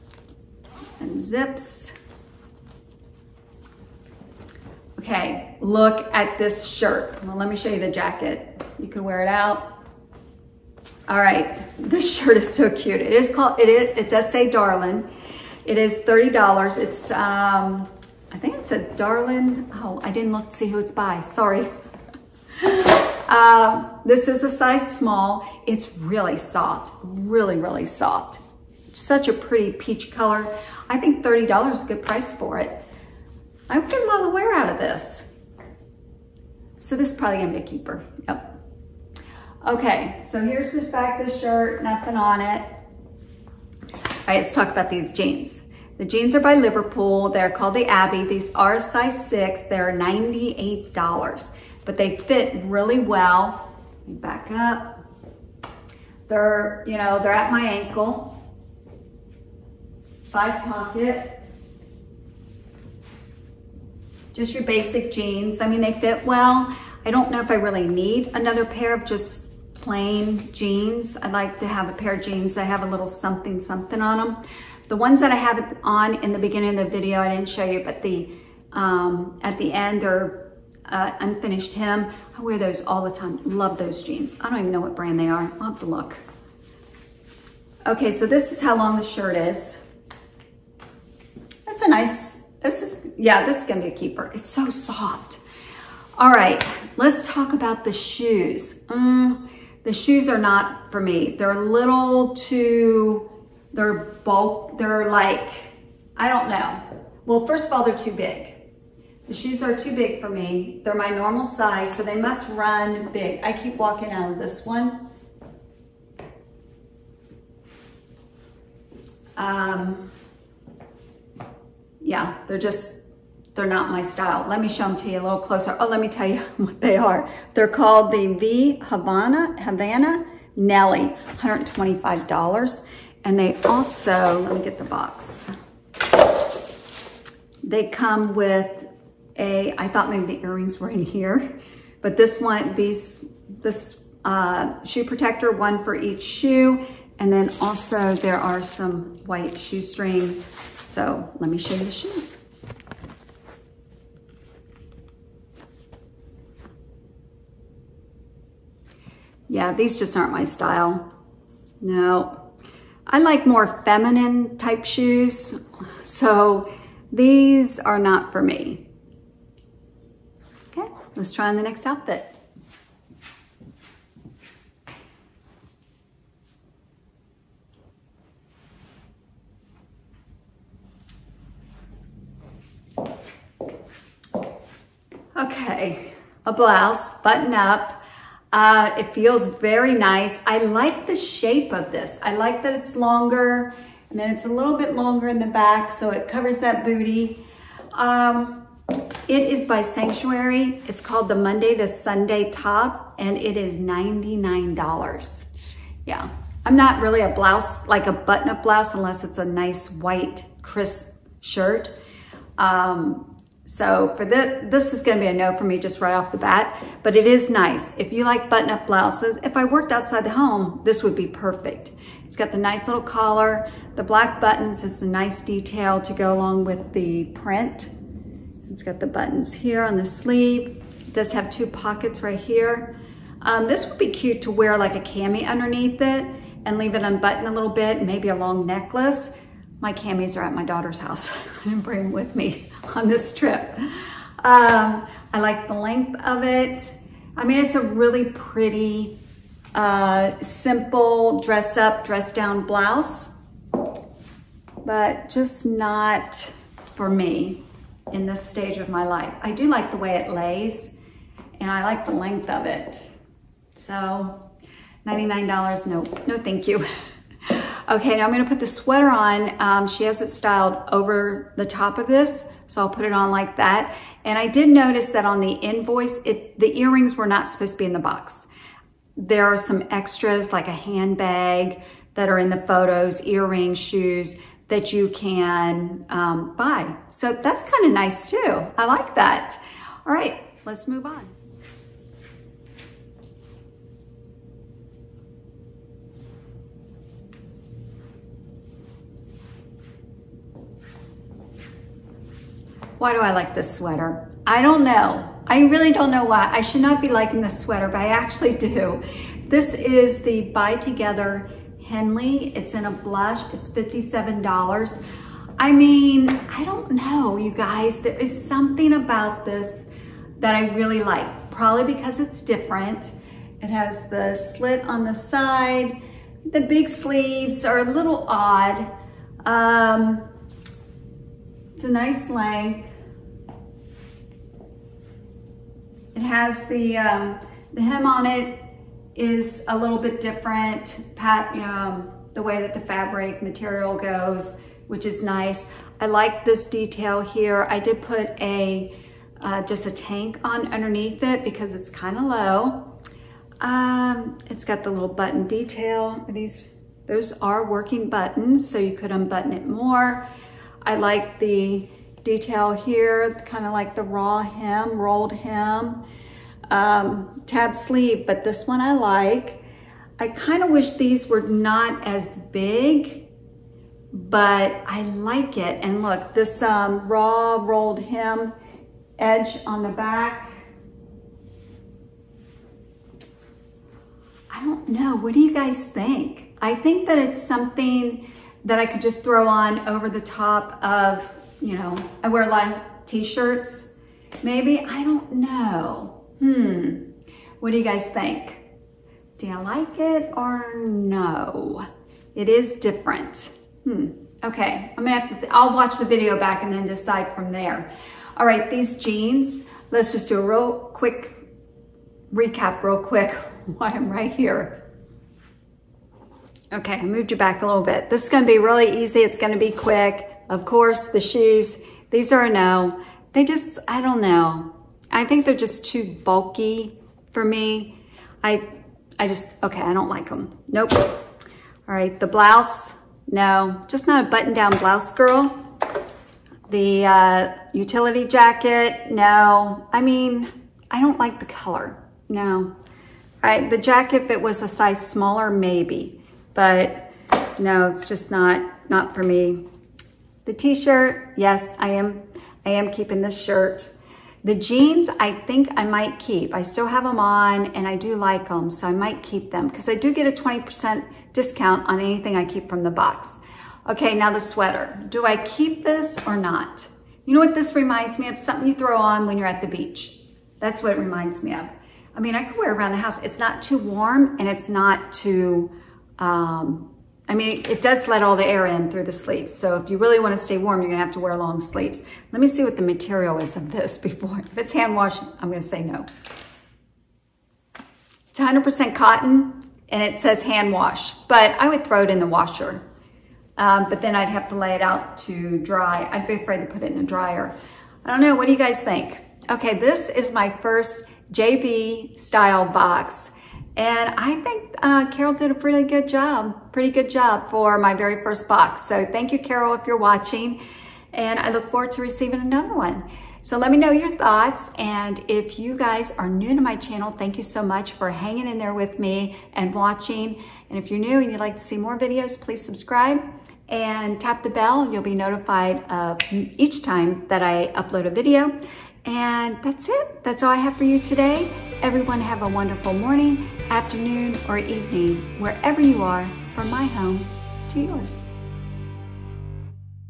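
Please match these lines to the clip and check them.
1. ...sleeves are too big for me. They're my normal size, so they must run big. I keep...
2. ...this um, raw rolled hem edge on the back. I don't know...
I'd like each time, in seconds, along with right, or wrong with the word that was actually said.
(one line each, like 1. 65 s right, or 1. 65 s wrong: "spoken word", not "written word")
1. 109 s wrong: "shoes", not "sleeves"
2. 376 s right.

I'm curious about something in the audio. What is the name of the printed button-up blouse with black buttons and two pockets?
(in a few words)
Monday to Sunday top.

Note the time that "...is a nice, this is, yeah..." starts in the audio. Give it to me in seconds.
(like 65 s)
89 s.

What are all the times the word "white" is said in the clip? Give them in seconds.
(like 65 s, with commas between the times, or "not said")
149 s, 209 s.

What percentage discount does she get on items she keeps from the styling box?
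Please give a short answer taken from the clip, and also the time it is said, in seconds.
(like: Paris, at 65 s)
20%, at 460 s.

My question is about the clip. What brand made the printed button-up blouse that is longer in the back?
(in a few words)
Sanctuary.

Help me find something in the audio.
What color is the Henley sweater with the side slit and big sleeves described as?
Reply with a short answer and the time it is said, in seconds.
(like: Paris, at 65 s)
Blush, at 312 s.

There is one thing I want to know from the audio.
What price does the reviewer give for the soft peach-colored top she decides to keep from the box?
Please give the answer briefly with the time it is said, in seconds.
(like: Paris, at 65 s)
$30, at 15 s.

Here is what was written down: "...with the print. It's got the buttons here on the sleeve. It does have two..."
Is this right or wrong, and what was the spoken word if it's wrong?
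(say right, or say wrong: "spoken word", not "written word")
right.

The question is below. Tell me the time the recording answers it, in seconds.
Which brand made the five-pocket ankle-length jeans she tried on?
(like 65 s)
46 s.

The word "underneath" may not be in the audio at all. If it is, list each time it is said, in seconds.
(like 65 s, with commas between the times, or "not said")
235 s, 350 s.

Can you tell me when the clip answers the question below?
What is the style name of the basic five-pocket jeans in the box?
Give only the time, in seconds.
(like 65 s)
47 s.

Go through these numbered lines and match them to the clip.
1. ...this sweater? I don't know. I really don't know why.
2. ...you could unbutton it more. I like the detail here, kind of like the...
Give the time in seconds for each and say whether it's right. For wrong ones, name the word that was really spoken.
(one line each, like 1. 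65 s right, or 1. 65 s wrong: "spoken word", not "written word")
1. 303 s right
2. 358 s right.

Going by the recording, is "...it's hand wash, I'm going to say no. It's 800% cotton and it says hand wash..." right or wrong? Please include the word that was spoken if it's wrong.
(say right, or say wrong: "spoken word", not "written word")
wrong: "100", not "800".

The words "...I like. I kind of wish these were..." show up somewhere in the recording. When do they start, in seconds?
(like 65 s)
368 s.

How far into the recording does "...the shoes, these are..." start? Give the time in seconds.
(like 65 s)
421 s.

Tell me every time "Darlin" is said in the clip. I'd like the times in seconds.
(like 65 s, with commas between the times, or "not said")
14 s, 18 s.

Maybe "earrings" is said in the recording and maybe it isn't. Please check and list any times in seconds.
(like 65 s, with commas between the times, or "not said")
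140 s, 276 s, 283 s.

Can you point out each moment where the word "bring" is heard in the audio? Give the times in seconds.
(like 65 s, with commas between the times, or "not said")
241 s.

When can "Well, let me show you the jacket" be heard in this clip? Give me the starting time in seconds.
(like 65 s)
7 s.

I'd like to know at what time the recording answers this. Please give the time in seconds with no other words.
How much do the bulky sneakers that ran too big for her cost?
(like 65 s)
131 s.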